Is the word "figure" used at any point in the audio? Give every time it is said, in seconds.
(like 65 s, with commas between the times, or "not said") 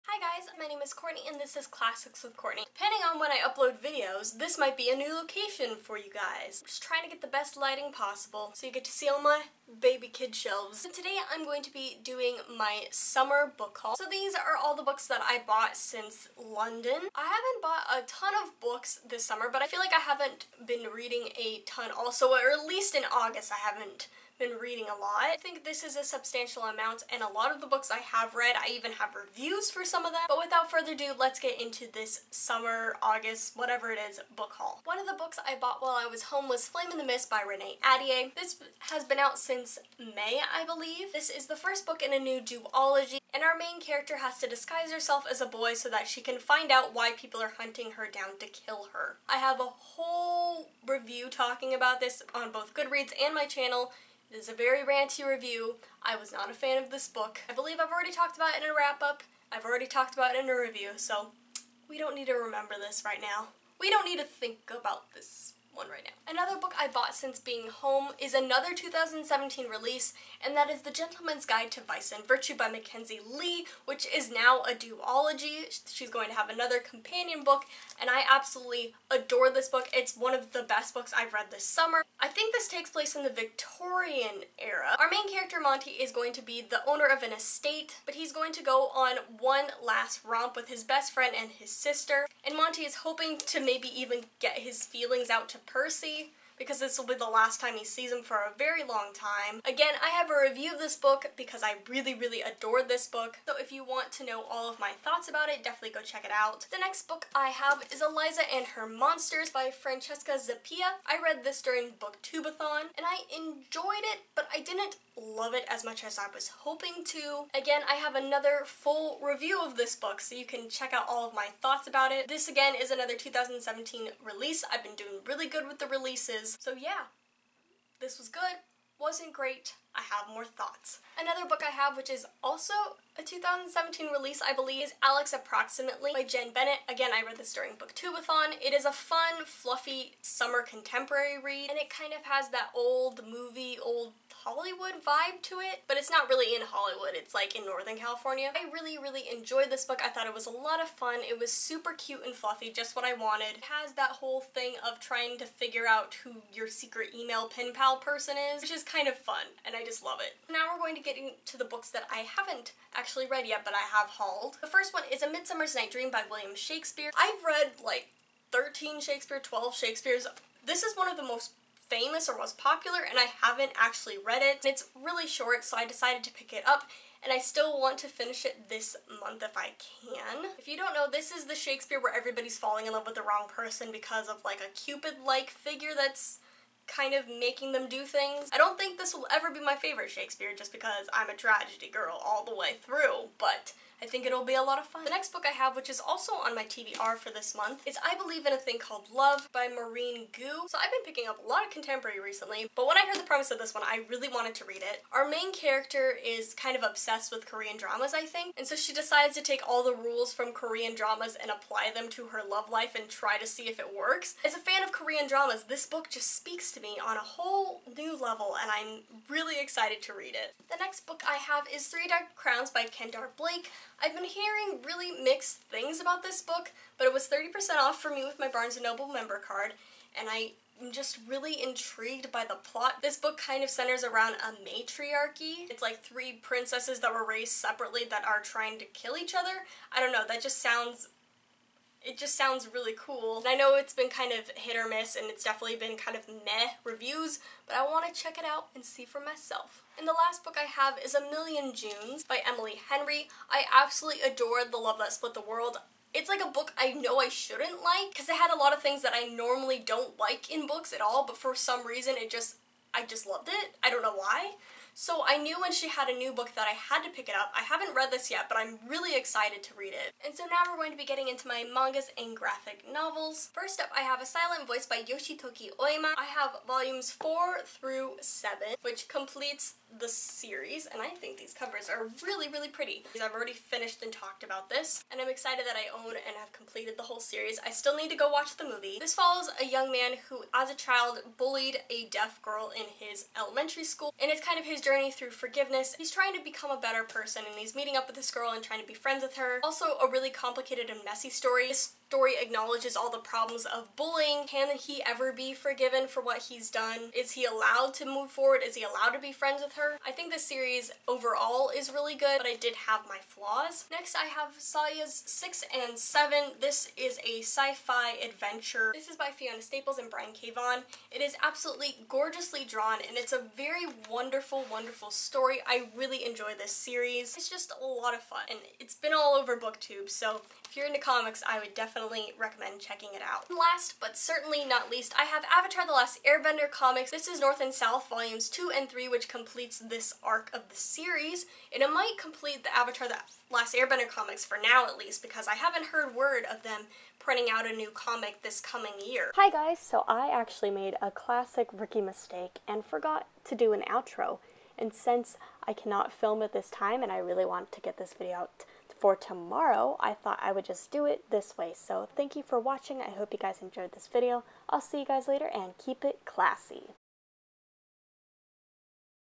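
155 s, 185 s.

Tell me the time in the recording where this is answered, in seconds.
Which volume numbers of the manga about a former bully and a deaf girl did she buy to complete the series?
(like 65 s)
277 s.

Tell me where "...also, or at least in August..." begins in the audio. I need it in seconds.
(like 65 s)
21 s.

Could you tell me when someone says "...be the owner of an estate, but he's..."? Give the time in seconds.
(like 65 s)
86 s.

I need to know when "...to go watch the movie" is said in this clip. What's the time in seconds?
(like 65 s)
288 s.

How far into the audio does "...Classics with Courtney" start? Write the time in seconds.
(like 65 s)
1 s.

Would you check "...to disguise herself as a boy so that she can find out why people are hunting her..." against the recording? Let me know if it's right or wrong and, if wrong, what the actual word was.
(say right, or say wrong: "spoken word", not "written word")
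right.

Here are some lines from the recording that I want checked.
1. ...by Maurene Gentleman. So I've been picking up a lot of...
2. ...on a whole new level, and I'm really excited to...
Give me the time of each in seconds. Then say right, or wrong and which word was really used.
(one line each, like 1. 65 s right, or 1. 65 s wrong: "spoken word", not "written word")
1. 199 s wrong: "Goo", not "Gentleman"
2. 217 s right.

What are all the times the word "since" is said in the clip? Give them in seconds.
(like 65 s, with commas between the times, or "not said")
15 s, 39 s, 67 s, 354 s.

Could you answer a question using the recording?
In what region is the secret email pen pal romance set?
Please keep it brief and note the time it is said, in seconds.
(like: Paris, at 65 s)
Northern California, at 147 s.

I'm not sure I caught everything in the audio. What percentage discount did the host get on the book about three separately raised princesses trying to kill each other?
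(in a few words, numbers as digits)
30%.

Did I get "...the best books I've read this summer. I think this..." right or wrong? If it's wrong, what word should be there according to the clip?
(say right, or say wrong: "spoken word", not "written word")
right.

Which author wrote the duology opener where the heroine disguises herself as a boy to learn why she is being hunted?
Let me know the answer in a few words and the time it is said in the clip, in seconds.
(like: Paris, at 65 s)
Renee Ahdieh, at 37 s.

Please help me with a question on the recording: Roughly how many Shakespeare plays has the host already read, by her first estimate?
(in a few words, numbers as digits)
13.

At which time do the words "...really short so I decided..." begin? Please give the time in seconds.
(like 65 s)
174 s.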